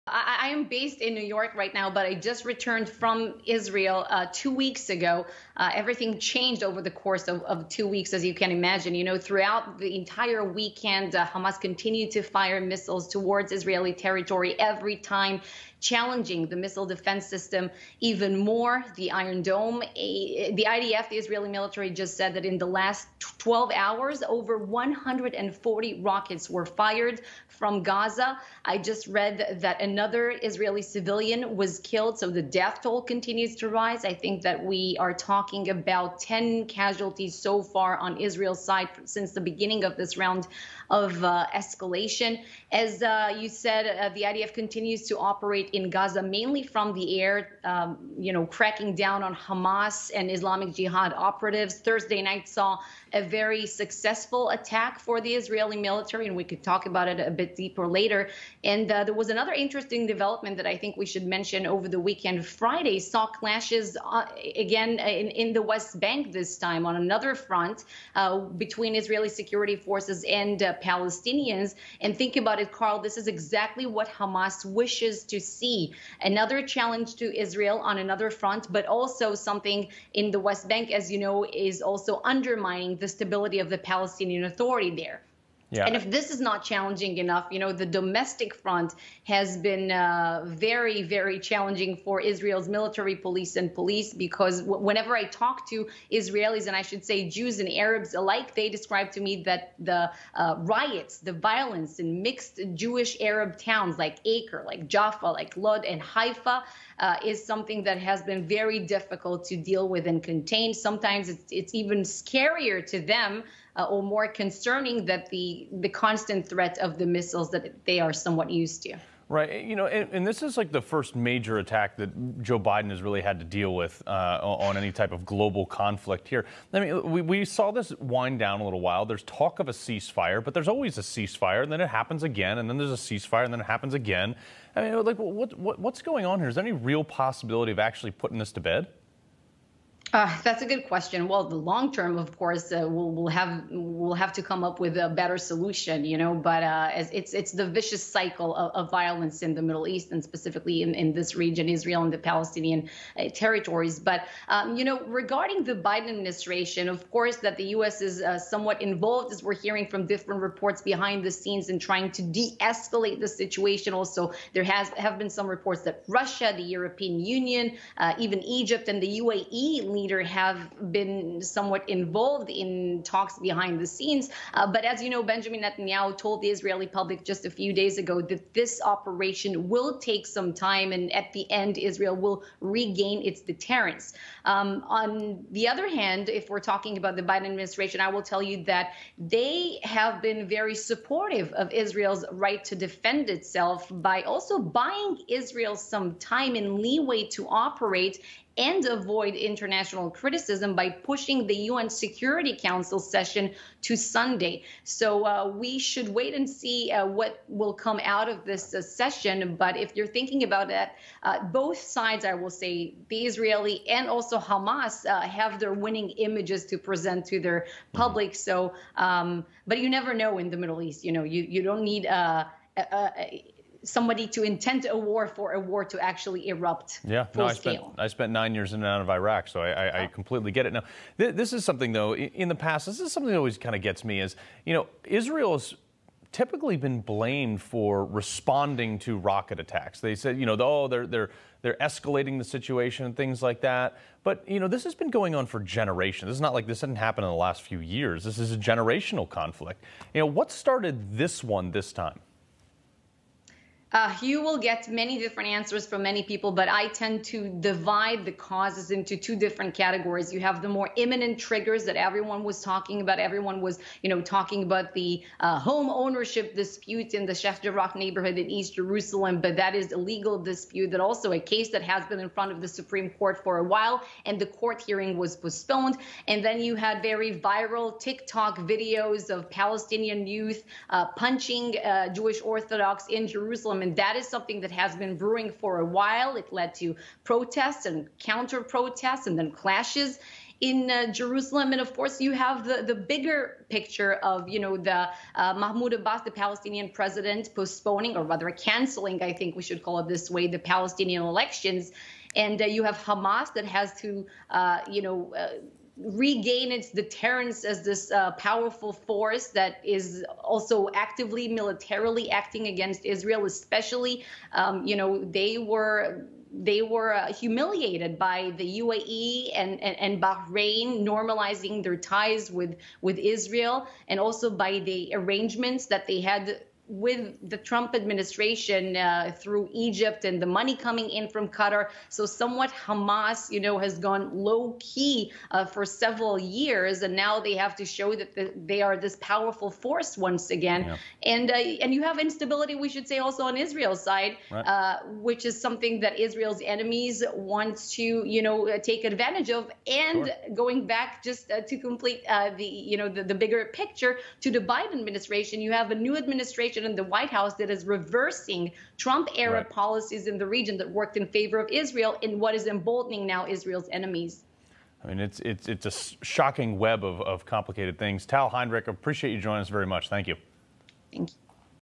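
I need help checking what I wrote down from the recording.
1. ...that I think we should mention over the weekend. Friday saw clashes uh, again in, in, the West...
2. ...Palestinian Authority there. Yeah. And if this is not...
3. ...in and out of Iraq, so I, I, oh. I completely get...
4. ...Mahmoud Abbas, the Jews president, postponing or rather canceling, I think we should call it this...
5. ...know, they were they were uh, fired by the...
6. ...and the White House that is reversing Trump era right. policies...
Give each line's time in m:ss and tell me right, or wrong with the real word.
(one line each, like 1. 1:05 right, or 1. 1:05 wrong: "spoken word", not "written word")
1. 1:00 right
2. 1:23 right
3. 3:48 right
4. 4:55 wrong: "Palestinian", not "Jews"
5. 5:14 wrong: "humiliated", not "fired"
6. 5:56 right.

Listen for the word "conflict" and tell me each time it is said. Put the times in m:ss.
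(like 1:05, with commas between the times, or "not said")
2:05, 4:09.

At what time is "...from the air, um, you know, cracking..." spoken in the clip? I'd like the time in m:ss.
0:46.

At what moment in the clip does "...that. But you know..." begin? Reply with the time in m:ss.
4:03.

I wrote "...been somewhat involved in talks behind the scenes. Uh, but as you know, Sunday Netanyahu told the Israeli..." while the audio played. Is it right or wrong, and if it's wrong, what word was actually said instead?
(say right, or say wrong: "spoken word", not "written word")
wrong: "Benjamin", not "Sunday".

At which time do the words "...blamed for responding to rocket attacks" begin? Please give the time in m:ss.
3:57.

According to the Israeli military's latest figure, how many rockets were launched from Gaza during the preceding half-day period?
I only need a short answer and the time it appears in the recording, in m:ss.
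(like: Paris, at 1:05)
over 140, at 0:24.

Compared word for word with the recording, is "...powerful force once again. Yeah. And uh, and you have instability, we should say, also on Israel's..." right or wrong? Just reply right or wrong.
right.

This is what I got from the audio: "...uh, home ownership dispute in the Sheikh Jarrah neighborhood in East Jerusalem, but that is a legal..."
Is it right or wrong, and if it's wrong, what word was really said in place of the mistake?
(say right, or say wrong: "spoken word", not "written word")
right.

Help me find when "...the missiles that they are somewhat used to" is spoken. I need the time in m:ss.
1:56.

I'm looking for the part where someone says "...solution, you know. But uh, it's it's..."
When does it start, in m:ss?
2:25.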